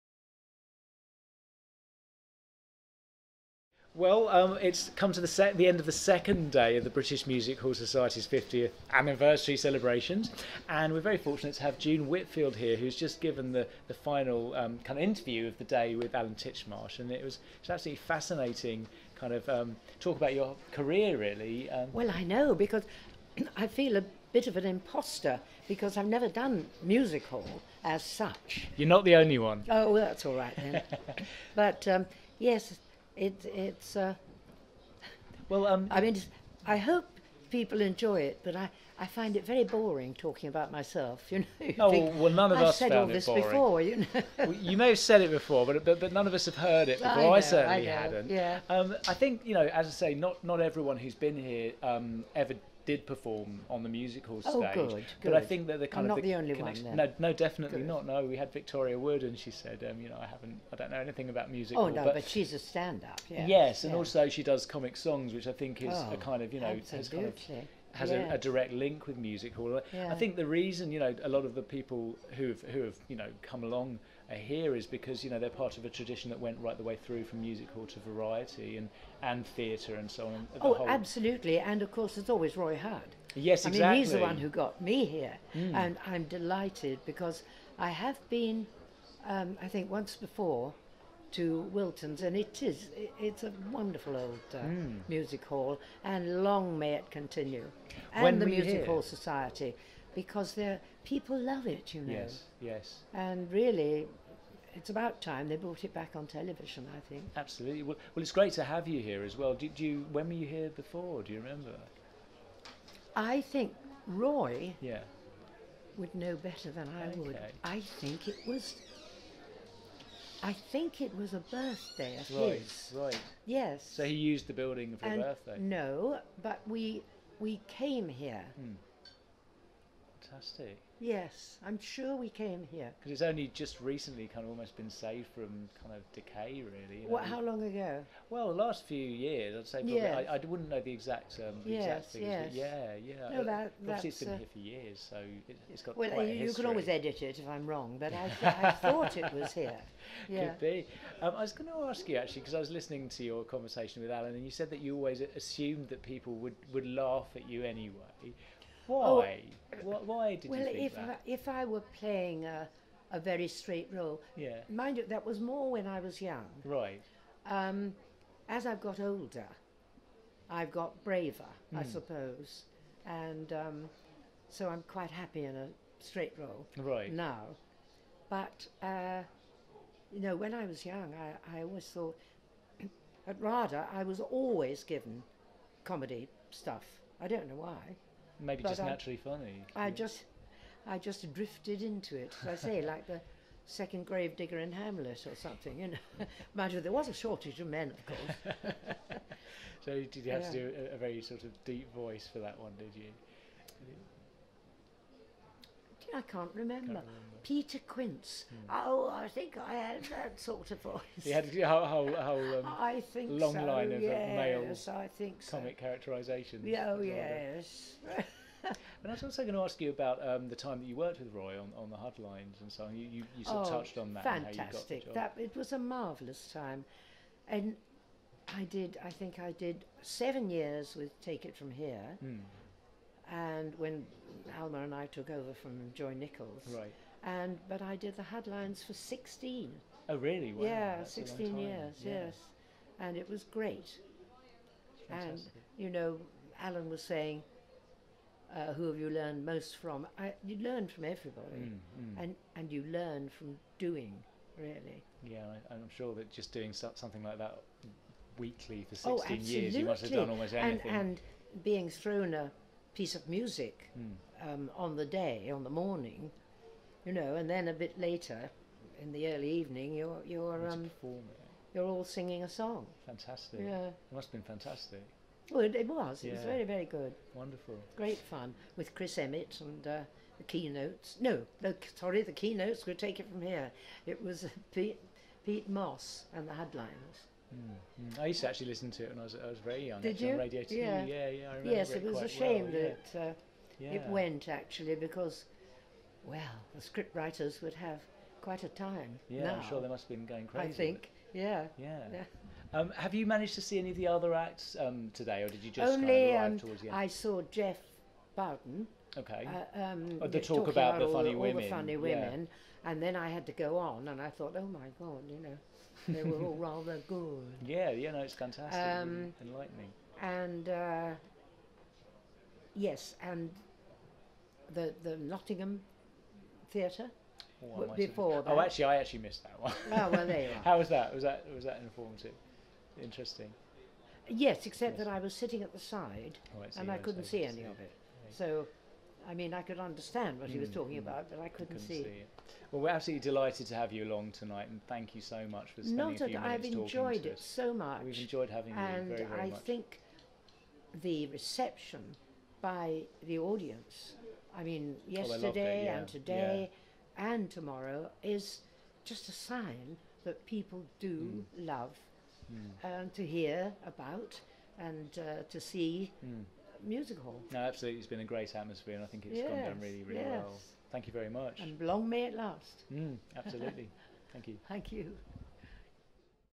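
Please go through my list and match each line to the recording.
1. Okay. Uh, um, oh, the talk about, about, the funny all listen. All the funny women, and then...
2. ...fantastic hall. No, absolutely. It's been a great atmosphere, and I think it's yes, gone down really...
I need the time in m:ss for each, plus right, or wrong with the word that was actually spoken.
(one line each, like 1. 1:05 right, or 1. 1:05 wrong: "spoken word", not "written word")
1. 5:09 wrong: "women", not "listen"
2. 6:06 wrong: "music", not "fantastic".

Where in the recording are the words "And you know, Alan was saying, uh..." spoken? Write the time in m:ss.
4:05.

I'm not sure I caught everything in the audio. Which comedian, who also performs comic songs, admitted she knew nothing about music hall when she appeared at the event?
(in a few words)
Victoria Wood.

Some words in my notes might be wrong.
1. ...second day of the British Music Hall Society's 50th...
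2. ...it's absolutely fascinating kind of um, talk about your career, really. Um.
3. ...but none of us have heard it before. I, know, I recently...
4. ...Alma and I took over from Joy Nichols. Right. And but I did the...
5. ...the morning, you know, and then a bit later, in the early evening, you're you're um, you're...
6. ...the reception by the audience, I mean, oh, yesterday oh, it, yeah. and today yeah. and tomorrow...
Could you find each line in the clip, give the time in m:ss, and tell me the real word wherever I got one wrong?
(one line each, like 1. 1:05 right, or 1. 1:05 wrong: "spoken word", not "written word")
1. 0:05 right
2. 0:17 right
3. 0:45 wrong: "certainly", not "recently"
4. 3:54 right
5. 4:25 right
6. 5:51 right.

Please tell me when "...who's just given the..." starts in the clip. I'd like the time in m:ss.
0:12.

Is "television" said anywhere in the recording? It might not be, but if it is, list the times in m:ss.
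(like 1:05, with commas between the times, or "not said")
1:46.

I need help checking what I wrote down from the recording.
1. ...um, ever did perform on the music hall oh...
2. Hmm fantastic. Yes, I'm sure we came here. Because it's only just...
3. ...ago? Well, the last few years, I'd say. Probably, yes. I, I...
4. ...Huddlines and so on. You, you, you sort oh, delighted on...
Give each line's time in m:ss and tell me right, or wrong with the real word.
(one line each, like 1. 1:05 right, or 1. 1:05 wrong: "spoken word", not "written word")
1. 0:51 right
2. 2:08 right
3. 2:17 right
4. 3:41 wrong: "touched", not "delighted".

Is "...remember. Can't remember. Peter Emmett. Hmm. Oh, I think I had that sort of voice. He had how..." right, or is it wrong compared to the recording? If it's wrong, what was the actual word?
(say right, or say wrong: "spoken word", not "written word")
wrong: "Quince", not "Emmett".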